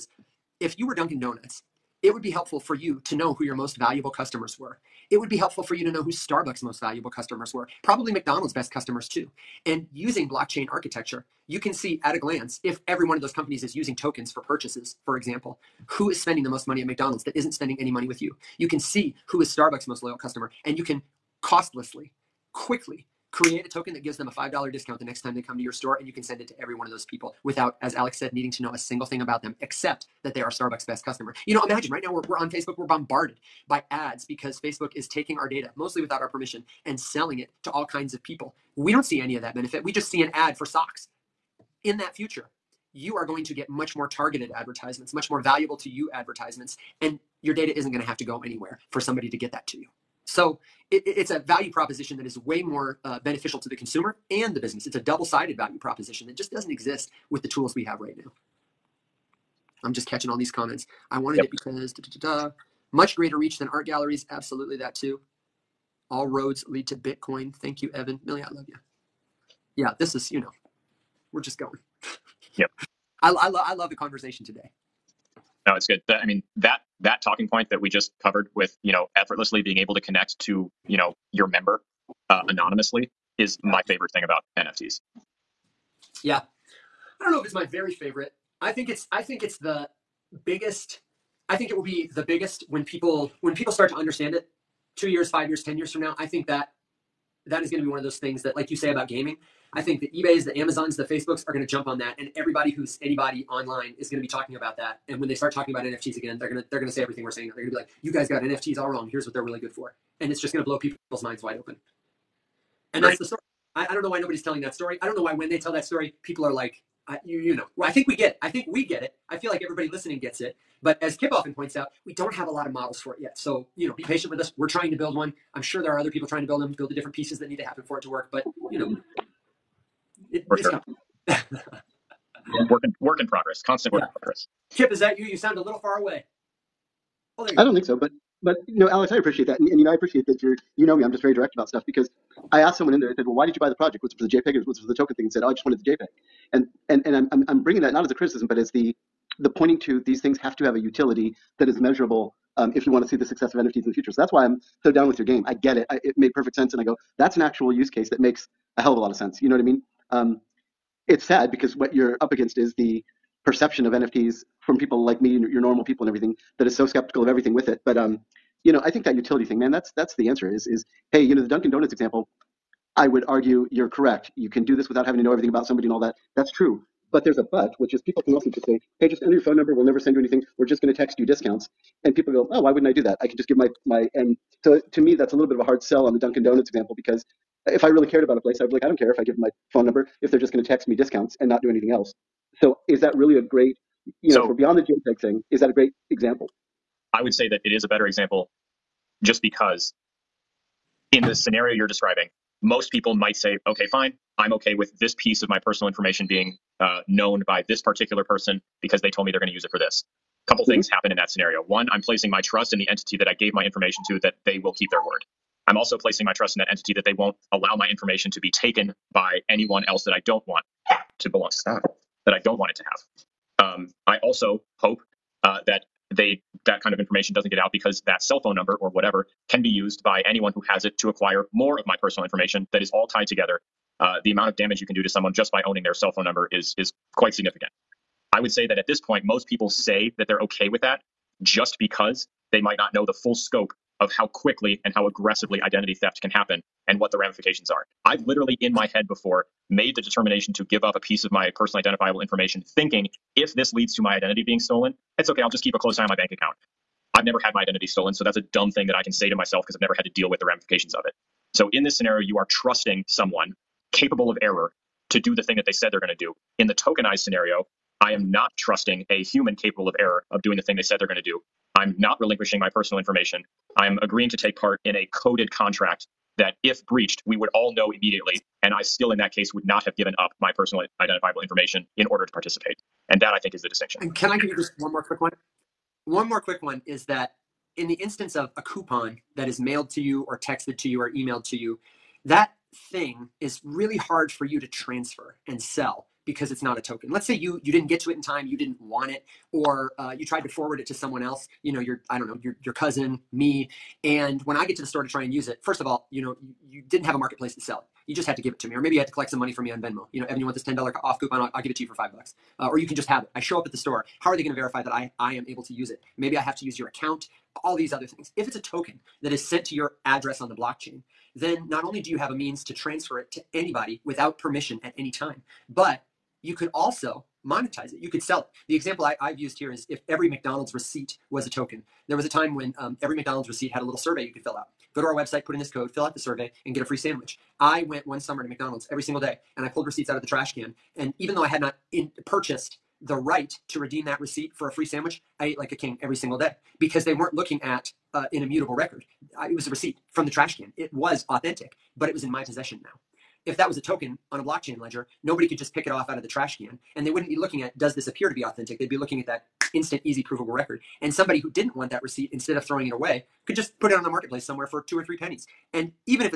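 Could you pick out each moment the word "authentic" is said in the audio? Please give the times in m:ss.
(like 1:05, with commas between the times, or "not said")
5:51, 5:58.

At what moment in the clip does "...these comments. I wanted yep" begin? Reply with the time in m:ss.
1:00.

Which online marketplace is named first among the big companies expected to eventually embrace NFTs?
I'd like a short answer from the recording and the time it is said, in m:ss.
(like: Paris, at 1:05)
eBay, at 1:40.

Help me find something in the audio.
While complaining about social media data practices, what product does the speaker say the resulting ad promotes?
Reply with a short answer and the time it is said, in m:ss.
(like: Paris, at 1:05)
Socks, at 0:40.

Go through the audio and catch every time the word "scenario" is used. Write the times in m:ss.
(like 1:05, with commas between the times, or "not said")
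3:21, 3:31, 4:21, 4:27.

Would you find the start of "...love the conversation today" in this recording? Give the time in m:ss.
1:13.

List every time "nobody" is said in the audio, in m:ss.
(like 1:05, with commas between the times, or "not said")
1:54, 5:55.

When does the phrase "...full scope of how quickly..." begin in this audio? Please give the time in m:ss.
4:03.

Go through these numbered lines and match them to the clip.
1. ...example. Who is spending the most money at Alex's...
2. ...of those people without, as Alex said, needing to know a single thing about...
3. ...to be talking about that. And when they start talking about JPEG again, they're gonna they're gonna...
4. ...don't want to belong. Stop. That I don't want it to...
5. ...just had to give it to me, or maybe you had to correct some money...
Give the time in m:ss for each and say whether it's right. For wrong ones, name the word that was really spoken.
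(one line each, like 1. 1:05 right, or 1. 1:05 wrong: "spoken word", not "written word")
1. 0:15 wrong: "McDonald", not "Alex"
2. 0:26 right
3. 1:44 wrong: "NFTs", not "JPEG"
4. 3:40 right
5. 5:08 wrong: "collect", not "correct".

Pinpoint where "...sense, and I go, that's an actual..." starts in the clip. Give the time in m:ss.
2:36.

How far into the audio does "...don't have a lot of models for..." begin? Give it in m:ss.
2:02.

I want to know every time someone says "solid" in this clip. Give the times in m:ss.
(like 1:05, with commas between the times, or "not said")
not said.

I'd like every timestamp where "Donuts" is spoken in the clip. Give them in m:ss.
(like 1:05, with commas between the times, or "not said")
0:01, 2:51, 3:06.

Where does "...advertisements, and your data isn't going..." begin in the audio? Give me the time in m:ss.
0:46.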